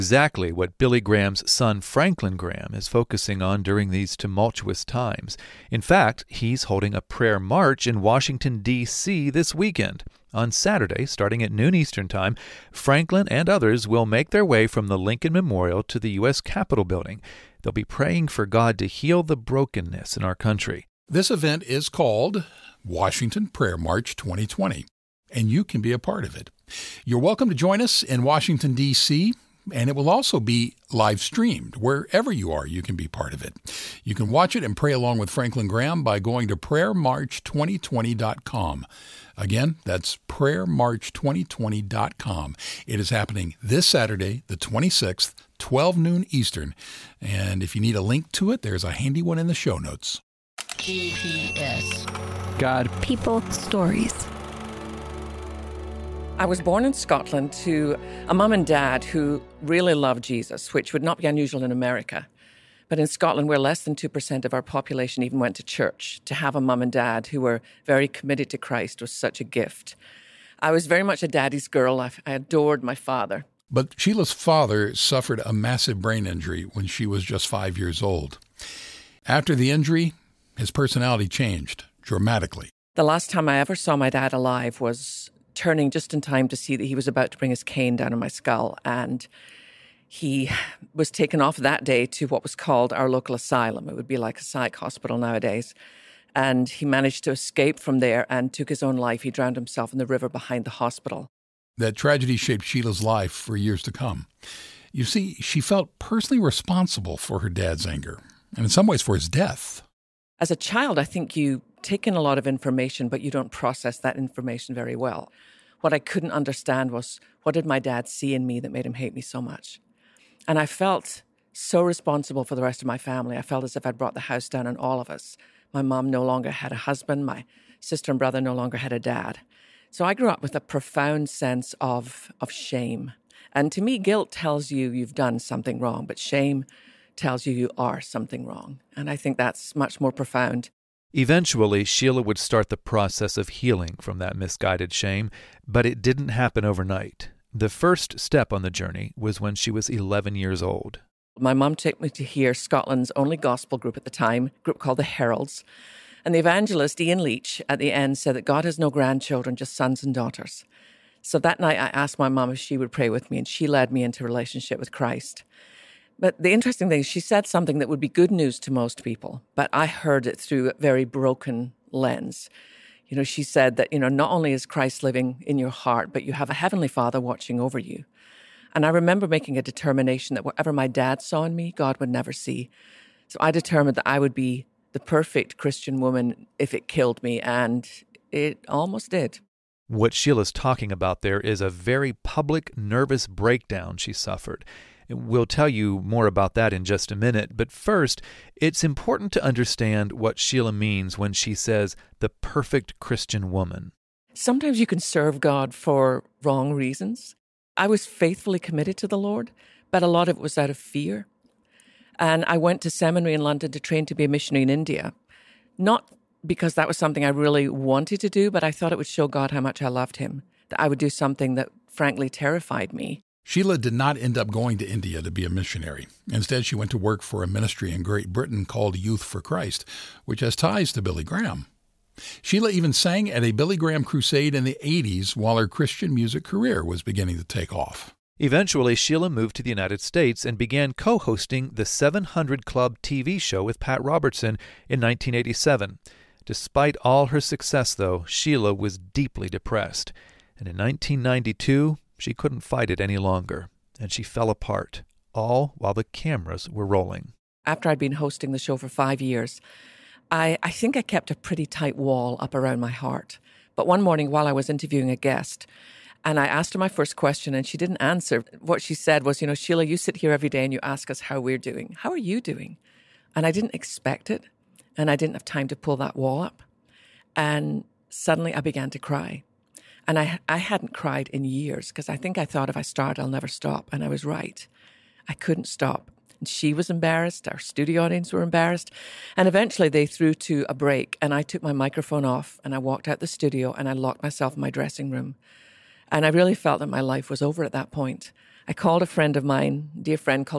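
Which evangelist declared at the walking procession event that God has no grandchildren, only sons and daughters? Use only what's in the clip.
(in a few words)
Ian Leitch.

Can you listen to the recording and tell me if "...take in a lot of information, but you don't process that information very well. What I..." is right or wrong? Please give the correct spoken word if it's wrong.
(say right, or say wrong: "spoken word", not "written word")
right.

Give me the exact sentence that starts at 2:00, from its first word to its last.
And I felt so responsible for the rest of my family.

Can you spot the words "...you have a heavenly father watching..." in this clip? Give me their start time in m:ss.
2:56.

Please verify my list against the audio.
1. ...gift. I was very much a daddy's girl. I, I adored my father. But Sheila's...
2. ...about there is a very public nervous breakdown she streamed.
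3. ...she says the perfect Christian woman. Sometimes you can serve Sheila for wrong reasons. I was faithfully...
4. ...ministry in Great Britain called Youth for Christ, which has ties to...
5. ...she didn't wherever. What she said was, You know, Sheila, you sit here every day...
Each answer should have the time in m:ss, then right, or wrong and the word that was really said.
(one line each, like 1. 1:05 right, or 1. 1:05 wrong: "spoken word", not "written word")
1. 1:09 right
2. 3:10 wrong: "suffered", not "streamed"
3. 3:21 wrong: "God", not "Sheila"
4. 3:47 right
5. 4:27 wrong: "answer", not "wherever".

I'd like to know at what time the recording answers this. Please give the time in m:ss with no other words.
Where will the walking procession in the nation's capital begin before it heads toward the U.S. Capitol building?
0:14.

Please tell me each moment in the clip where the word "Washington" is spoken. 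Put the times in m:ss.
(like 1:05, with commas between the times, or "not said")
0:08, 0:22, 0:28.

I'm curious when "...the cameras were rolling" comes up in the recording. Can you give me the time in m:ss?
4:15.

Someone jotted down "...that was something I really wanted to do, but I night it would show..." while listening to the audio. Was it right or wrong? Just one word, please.
wrong.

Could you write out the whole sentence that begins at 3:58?
Eventually, Sheila moved to the United States and began co hosting the 700 Club TV show with Pat Robertson in 1987.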